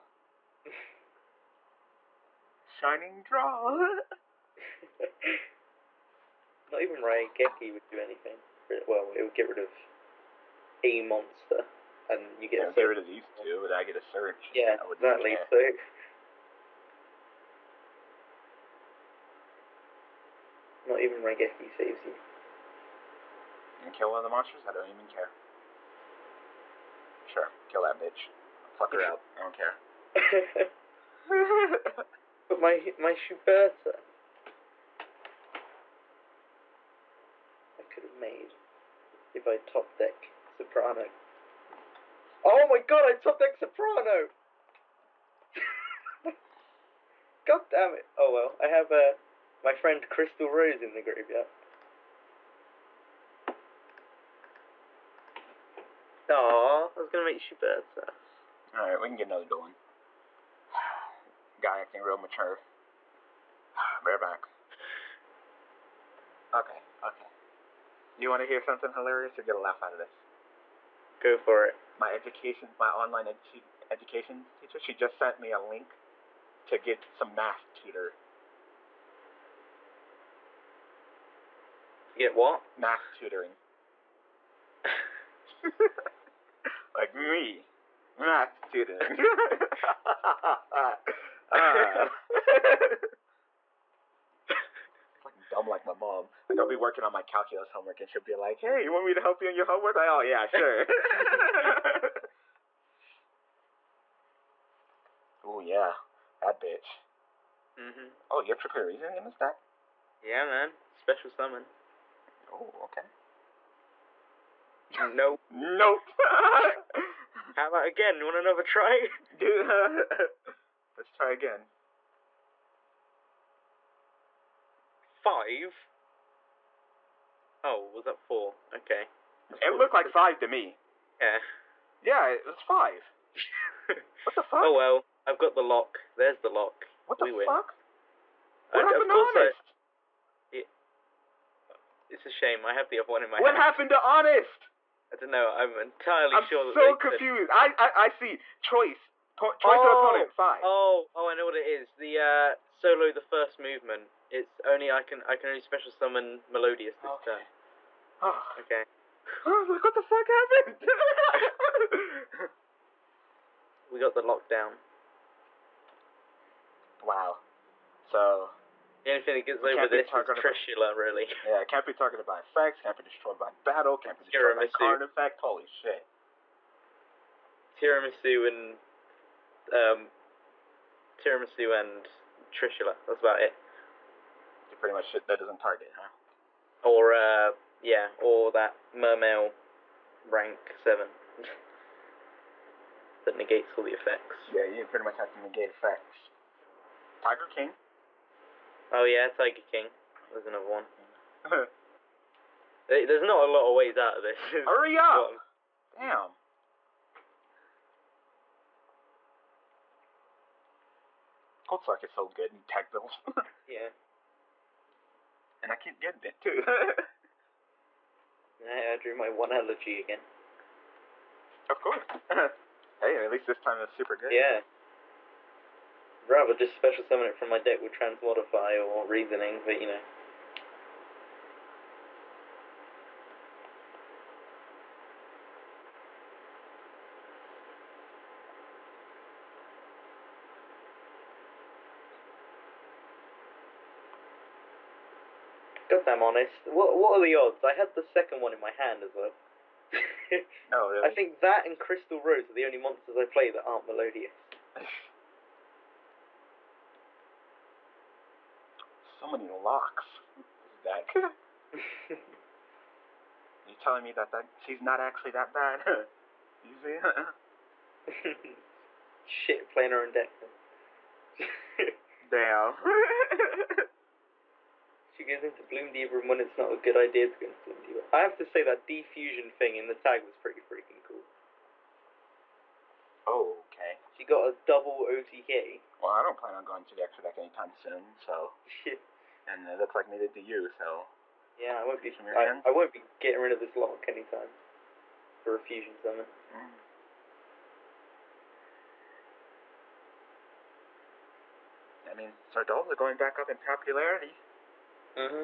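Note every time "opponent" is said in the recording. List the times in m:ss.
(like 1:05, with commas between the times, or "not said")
2:30.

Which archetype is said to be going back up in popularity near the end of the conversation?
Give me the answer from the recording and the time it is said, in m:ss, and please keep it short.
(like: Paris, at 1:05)
Shaddoll, at 5:02.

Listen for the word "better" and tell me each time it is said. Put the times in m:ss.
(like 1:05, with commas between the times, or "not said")
0:57.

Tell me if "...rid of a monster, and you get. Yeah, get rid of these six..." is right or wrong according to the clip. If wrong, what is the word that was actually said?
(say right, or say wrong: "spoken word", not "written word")
wrong: "two", not "six".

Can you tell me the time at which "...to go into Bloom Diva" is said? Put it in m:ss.
4:37.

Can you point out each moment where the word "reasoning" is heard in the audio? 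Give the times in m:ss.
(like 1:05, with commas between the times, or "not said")
1:48, 3:49.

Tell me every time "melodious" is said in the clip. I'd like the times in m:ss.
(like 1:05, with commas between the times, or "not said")
2:36, 4:13.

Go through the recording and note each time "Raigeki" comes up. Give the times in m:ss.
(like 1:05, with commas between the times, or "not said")
0:06, 0:21.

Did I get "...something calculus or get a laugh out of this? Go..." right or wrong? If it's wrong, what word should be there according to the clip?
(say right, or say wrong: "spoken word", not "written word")
wrong: "hilarious", not "calculus".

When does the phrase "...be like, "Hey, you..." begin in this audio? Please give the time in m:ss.
1:38.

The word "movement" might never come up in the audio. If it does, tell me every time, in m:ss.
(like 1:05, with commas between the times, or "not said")
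2:33.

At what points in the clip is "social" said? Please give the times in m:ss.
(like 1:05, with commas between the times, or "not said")
not said.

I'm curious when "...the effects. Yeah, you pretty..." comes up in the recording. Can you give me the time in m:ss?
3:13.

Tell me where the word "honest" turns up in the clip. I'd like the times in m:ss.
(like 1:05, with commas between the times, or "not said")
2:19, 2:24, 4:06.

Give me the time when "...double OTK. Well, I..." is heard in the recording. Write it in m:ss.
4:44.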